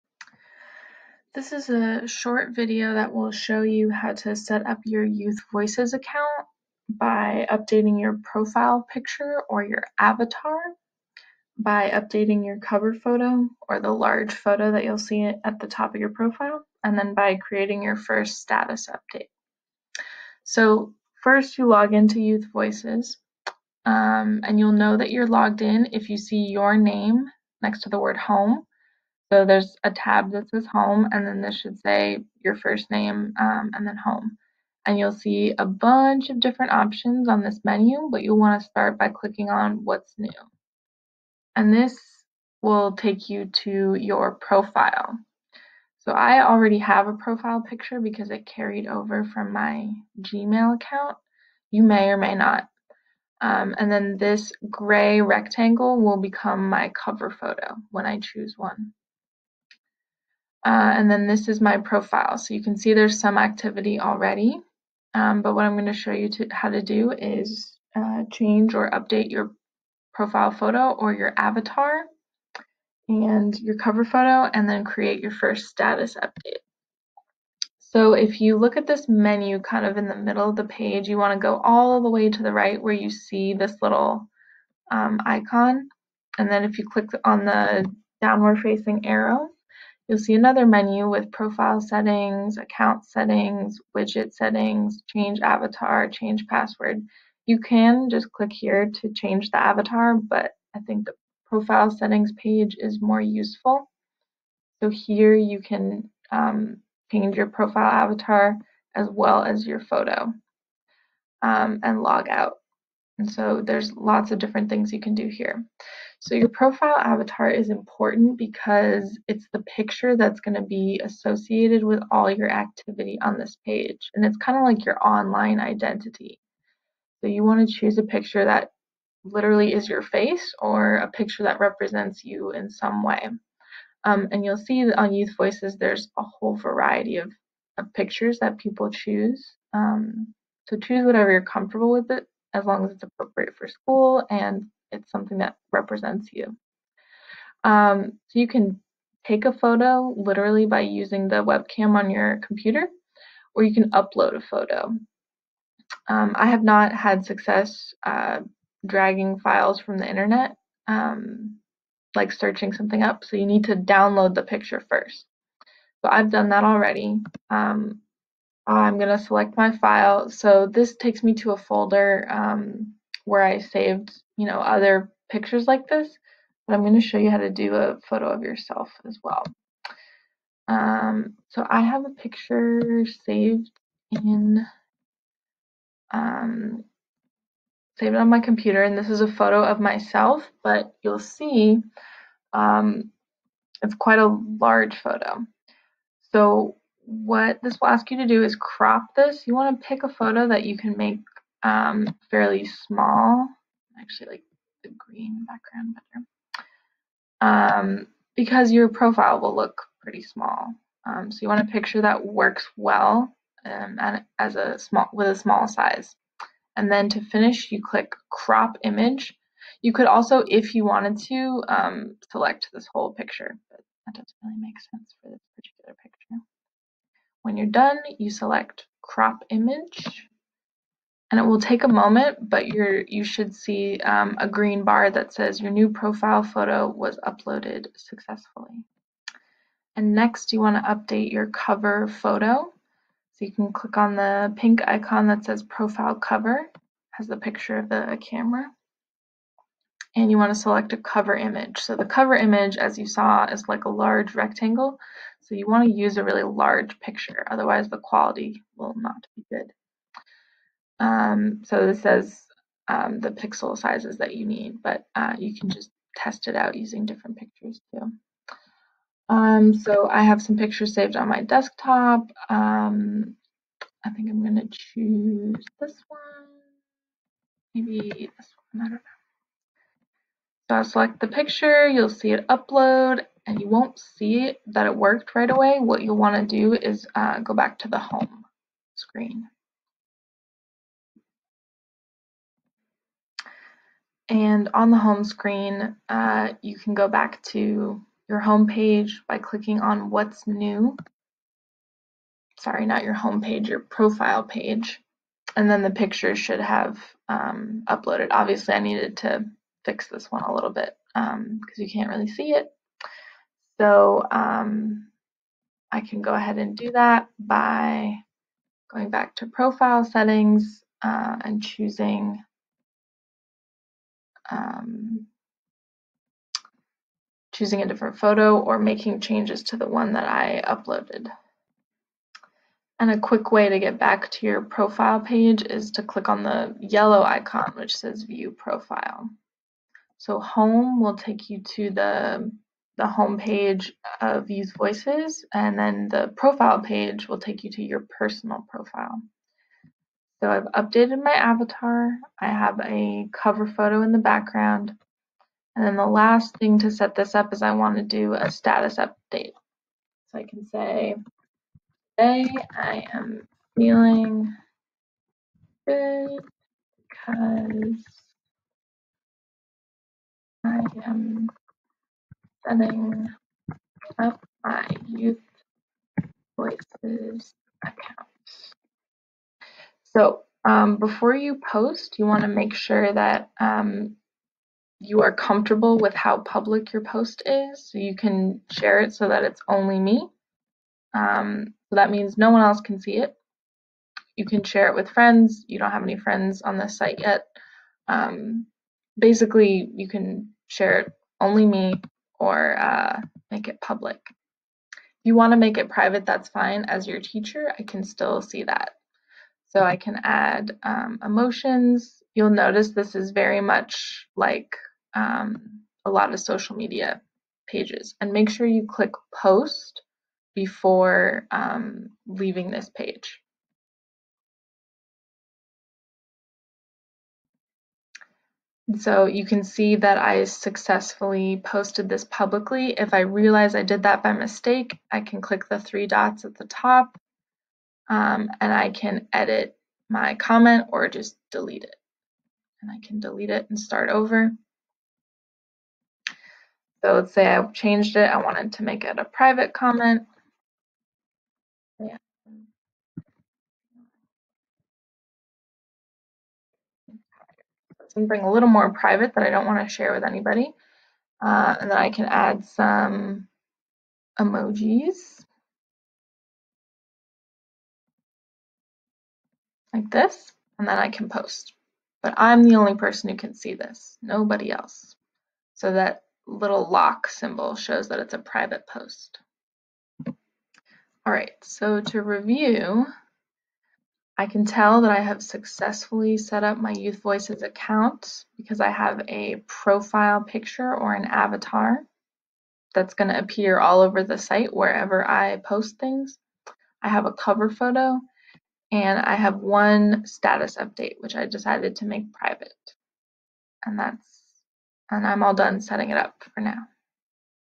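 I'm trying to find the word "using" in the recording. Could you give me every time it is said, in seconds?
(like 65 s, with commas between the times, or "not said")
150 s, 266 s.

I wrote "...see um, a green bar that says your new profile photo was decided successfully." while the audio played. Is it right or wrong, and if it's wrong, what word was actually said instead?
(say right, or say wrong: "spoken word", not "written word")
wrong: "uploaded", not "decided".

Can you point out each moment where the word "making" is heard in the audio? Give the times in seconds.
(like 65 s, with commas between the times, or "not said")
328 s.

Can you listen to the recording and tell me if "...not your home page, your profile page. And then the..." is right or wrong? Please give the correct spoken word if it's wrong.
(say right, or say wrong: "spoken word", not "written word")
right.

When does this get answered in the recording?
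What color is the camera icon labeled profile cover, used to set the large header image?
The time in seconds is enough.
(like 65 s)
244 s.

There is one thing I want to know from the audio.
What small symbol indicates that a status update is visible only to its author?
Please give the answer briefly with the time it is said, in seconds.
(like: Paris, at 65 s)
lock symbol, at 476 s.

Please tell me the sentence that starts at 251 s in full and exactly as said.
So the cover image, as you saw, is like a large rectangle.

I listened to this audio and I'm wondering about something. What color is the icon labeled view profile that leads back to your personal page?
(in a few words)
yellow.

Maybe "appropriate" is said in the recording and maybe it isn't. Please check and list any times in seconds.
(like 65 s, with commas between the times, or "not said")
143 s.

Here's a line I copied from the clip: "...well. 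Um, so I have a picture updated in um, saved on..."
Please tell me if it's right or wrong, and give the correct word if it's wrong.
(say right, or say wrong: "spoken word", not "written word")
wrong: "saved", not "updated".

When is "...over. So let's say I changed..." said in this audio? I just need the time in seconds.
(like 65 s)
444 s.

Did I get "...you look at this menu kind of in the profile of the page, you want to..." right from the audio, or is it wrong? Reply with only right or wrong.
wrong.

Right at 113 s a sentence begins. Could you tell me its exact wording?
And so there's lots of different things you can do here.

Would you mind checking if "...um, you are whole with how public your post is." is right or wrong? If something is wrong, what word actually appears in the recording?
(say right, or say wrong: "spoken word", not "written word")
wrong: "comfortable", not "whole".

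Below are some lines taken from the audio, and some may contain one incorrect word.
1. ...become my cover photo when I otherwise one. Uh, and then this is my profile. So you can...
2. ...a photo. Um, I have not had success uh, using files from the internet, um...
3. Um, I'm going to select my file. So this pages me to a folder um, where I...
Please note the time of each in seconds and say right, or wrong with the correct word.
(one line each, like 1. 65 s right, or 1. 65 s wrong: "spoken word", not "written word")
1. 56 s wrong: "choose", not "otherwise"
2. 154 s wrong: "dragging", not "using"
3. 167 s wrong: "takes", not "pages".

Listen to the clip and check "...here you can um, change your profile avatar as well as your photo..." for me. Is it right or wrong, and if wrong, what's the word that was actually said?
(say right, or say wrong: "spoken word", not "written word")
right.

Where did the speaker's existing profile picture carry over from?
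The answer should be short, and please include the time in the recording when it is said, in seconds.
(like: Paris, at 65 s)
Gmail account, at 49 s.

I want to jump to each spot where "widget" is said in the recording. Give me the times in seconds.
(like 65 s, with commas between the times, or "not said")
93 s.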